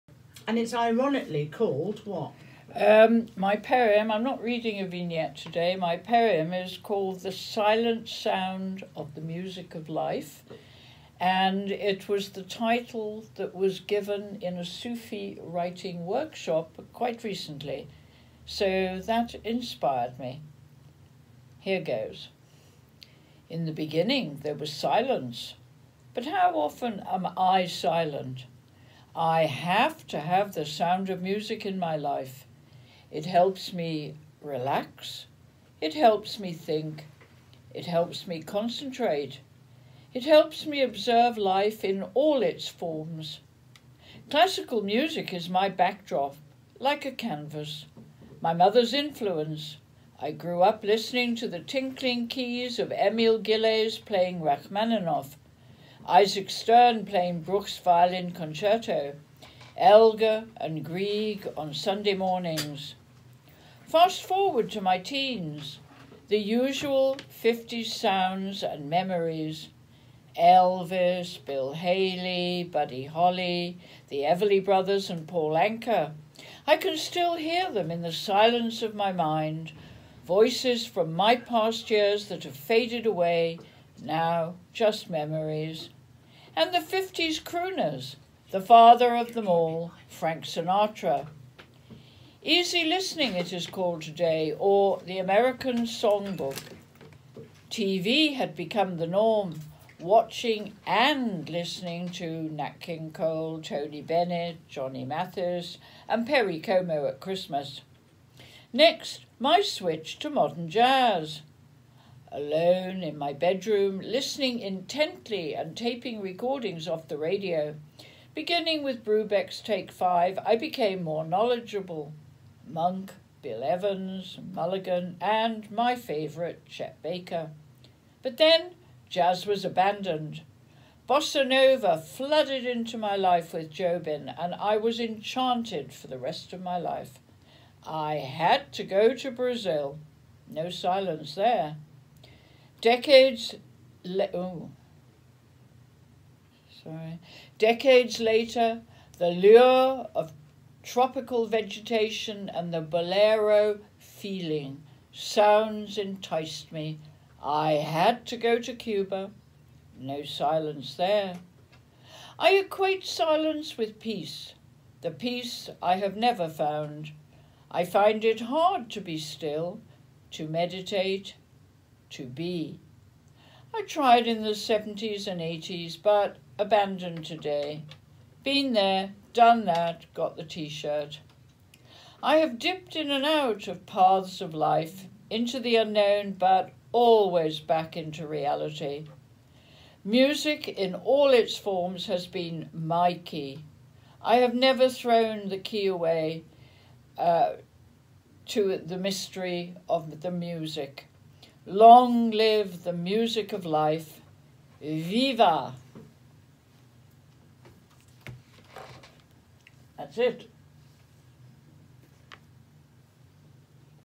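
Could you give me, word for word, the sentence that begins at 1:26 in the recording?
And the 50s crooners, the father of them all, Frank Sinatra.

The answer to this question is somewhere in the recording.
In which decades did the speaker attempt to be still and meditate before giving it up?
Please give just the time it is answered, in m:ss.
2:54.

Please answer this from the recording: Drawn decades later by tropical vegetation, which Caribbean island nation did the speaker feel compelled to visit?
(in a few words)
Cuba.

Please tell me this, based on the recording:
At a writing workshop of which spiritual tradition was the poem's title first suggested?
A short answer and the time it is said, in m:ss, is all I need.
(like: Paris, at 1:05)
Sufi, at 0:14.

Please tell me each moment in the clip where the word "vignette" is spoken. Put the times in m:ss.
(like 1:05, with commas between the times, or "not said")
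0:04.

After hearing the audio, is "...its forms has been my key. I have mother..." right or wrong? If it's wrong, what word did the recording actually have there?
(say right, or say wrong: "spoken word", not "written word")
wrong: "never", not "mother".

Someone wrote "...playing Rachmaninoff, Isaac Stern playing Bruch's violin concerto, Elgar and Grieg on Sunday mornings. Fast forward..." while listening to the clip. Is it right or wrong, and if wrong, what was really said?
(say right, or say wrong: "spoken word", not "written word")
right.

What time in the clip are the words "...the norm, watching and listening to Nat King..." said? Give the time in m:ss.
1:38.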